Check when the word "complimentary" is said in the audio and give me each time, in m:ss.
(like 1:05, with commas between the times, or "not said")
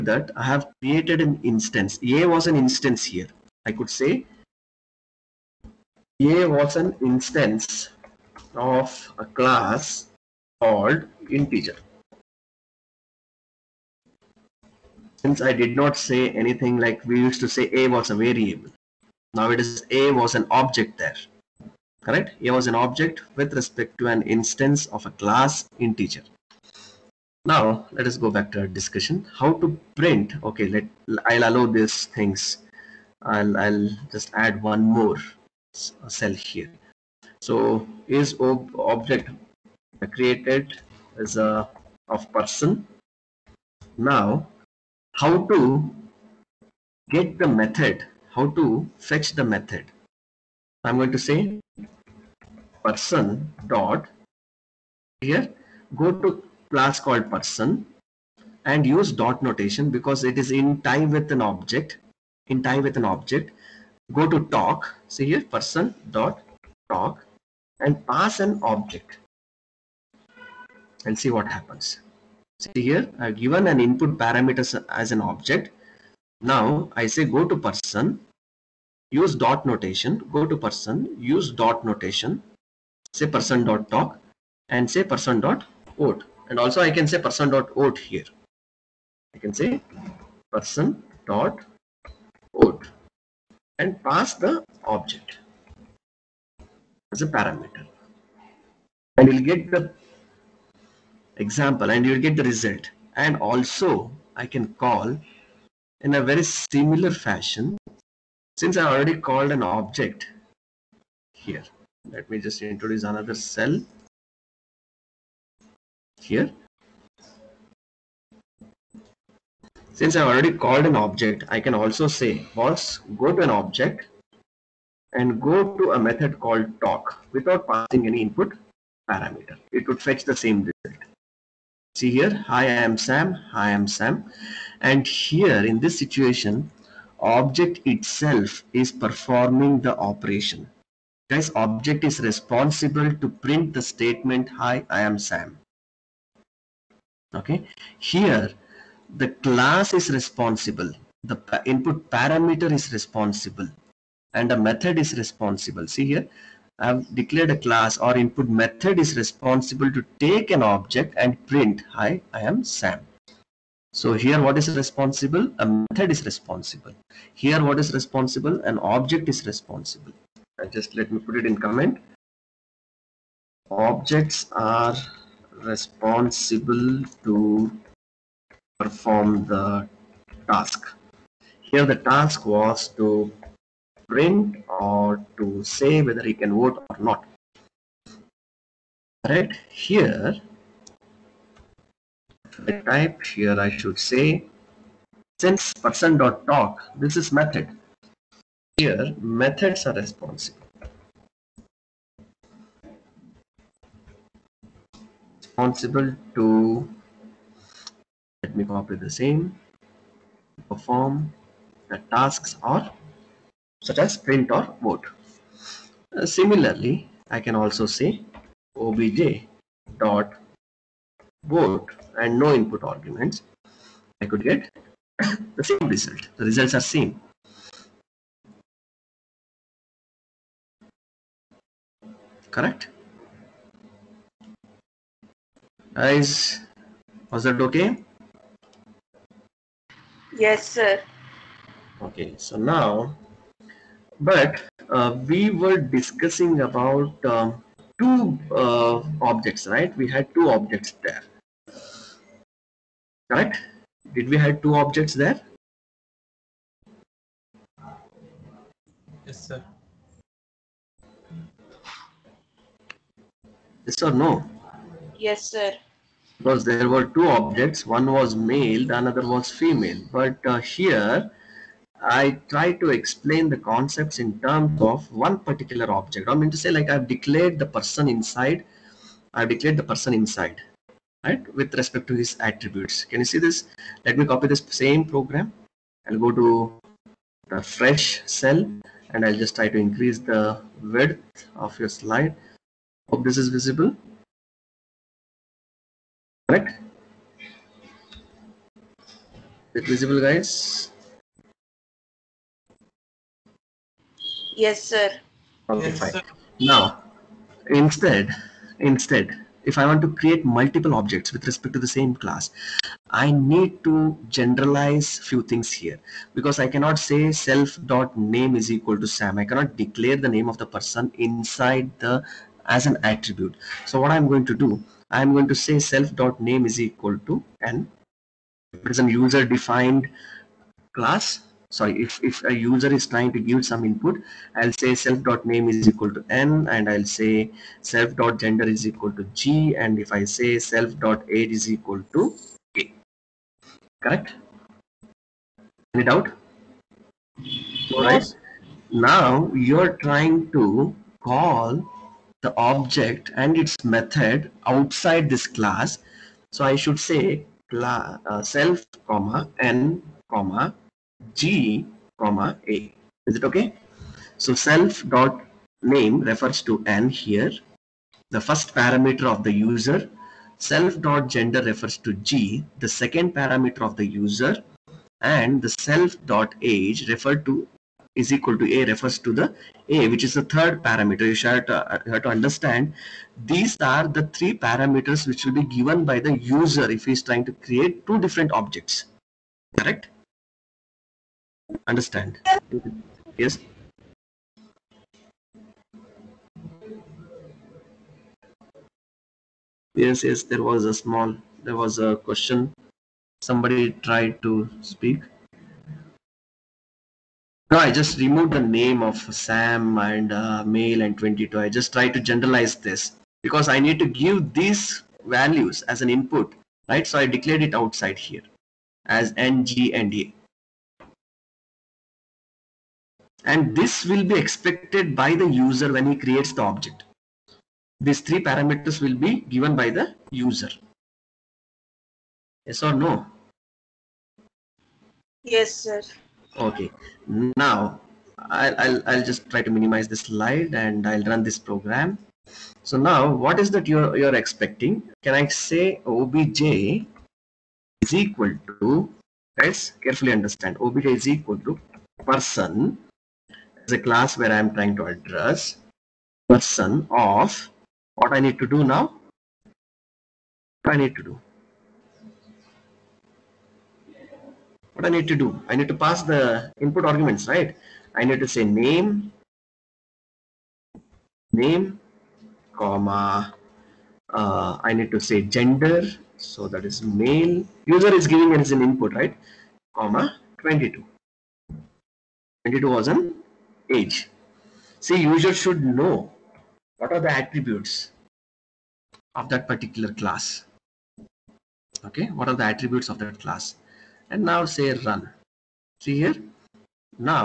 not said.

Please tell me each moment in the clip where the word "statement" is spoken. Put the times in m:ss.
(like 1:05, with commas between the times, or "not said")
2:23.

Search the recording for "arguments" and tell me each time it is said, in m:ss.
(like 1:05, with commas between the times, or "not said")
3:42, 7:47.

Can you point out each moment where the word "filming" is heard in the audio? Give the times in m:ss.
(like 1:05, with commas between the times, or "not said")
not said.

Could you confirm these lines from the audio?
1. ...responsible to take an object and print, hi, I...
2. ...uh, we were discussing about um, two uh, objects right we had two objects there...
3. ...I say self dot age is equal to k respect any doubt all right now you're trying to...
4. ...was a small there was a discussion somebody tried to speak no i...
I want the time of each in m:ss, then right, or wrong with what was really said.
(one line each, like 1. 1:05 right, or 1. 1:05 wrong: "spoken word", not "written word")
1. 2:39 right
2. 4:04 right
3. 5:40 wrong: "correct", not "respect"
4. 6:40 wrong: "question", not "discussion".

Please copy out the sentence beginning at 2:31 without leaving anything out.
The input parameter is responsible and a method is responsible.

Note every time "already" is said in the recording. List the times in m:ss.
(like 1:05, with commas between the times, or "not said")
1:48, 2:00.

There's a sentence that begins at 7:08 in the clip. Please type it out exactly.
These three parameters will be given by the user.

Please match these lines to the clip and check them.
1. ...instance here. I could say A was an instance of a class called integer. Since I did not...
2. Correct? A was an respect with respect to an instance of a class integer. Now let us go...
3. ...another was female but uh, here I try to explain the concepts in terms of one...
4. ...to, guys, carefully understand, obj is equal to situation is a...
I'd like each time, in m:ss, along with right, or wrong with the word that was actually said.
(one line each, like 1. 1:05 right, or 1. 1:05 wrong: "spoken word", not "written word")
1. 0:02 right
2. 0:22 wrong: "object", not "respect"
3. 4:29 right
4. 7:28 wrong: "person", not "situation".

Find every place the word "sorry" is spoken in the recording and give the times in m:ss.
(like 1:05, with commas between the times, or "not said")
5:31.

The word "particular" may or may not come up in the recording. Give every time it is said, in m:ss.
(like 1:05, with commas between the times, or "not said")
4:35, 8:09.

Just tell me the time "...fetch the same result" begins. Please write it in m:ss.
2:10.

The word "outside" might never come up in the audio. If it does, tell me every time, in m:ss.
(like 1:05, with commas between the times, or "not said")
5:54, 6:57.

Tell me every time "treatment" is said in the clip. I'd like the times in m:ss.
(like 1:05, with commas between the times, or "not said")
not said.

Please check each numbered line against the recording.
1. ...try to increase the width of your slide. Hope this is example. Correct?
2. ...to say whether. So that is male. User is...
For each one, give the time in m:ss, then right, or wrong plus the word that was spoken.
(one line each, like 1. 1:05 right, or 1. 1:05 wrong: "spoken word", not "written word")
1. 4:49 wrong: "visible", not "example"
2. 7:55 wrong: "gender", not "whether".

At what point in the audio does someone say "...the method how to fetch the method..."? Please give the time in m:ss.
0:47.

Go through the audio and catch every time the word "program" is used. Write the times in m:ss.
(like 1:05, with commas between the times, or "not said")
4:45, 7:21.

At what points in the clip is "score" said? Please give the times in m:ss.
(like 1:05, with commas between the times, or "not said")
not said.